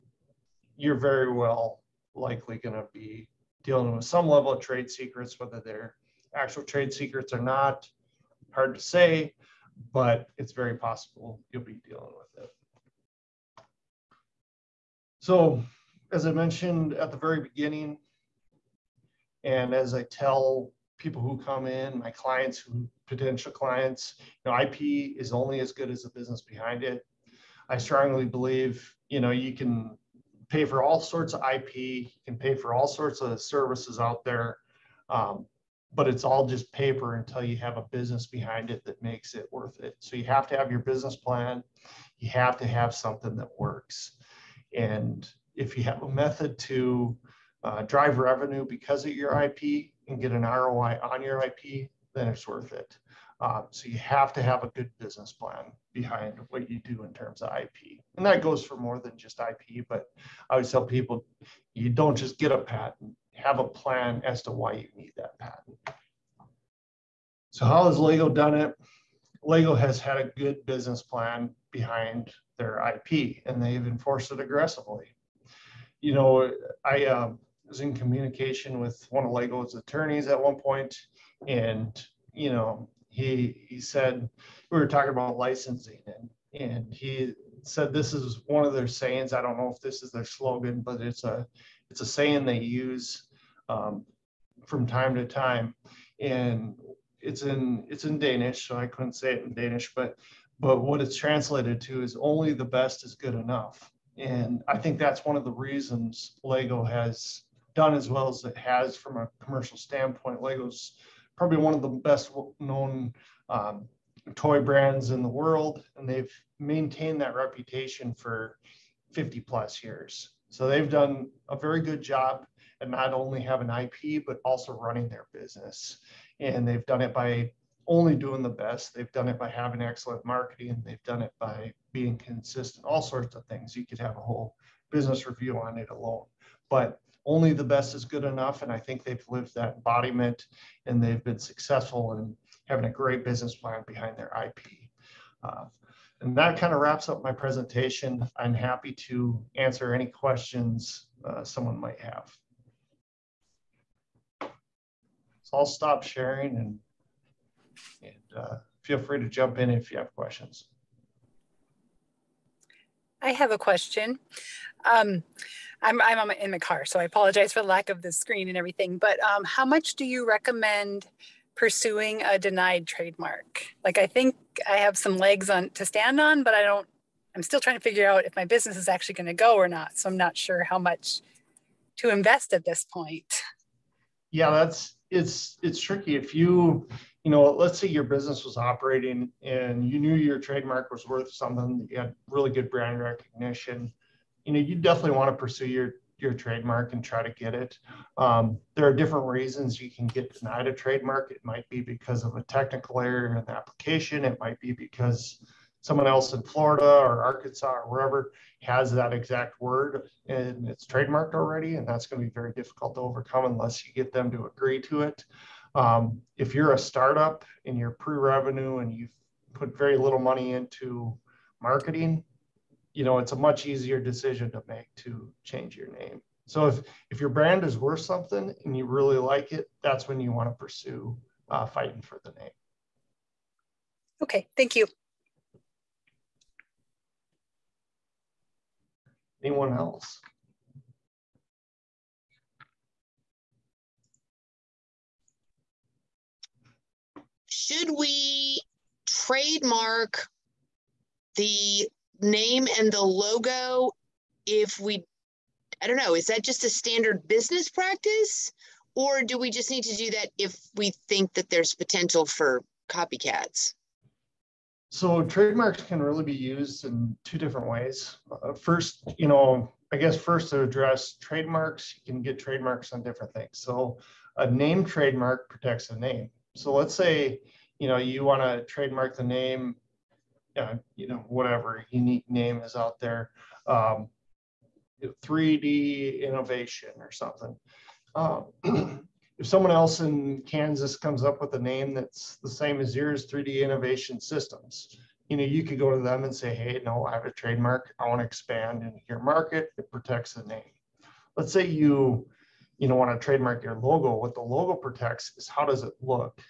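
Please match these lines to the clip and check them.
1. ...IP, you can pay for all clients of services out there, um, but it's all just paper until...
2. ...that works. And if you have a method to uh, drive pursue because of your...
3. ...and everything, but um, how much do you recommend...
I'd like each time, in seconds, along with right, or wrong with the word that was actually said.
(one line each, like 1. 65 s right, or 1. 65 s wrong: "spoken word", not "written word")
1. 31 s wrong: "sorts", not "clients"
2. 43 s wrong: "revenue", not "pursue"
3. 168 s right.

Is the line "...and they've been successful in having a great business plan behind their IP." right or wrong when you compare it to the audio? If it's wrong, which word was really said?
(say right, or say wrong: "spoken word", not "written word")
right.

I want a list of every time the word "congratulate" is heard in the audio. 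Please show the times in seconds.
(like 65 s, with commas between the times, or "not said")
not said.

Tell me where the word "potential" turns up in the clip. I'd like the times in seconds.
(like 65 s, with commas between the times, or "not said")
23 s, 261 s.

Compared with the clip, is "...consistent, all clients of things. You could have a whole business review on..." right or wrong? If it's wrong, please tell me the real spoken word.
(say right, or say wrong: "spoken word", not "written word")
wrong: "sorts", not "clients".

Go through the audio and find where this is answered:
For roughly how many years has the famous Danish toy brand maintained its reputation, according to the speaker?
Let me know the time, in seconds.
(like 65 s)
119 s.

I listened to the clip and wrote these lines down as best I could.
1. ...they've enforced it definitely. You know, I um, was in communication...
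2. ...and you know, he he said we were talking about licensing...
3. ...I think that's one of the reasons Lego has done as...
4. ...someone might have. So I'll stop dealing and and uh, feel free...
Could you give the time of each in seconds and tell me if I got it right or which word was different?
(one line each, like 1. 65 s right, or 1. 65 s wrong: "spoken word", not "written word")
1. 73 s wrong: "aggressively", not "definitely"
2. 81 s right
3. 104 s right
4. 151 s wrong: "sharing", not "dealing".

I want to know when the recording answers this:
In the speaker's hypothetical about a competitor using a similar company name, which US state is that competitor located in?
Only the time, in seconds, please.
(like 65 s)
290 s.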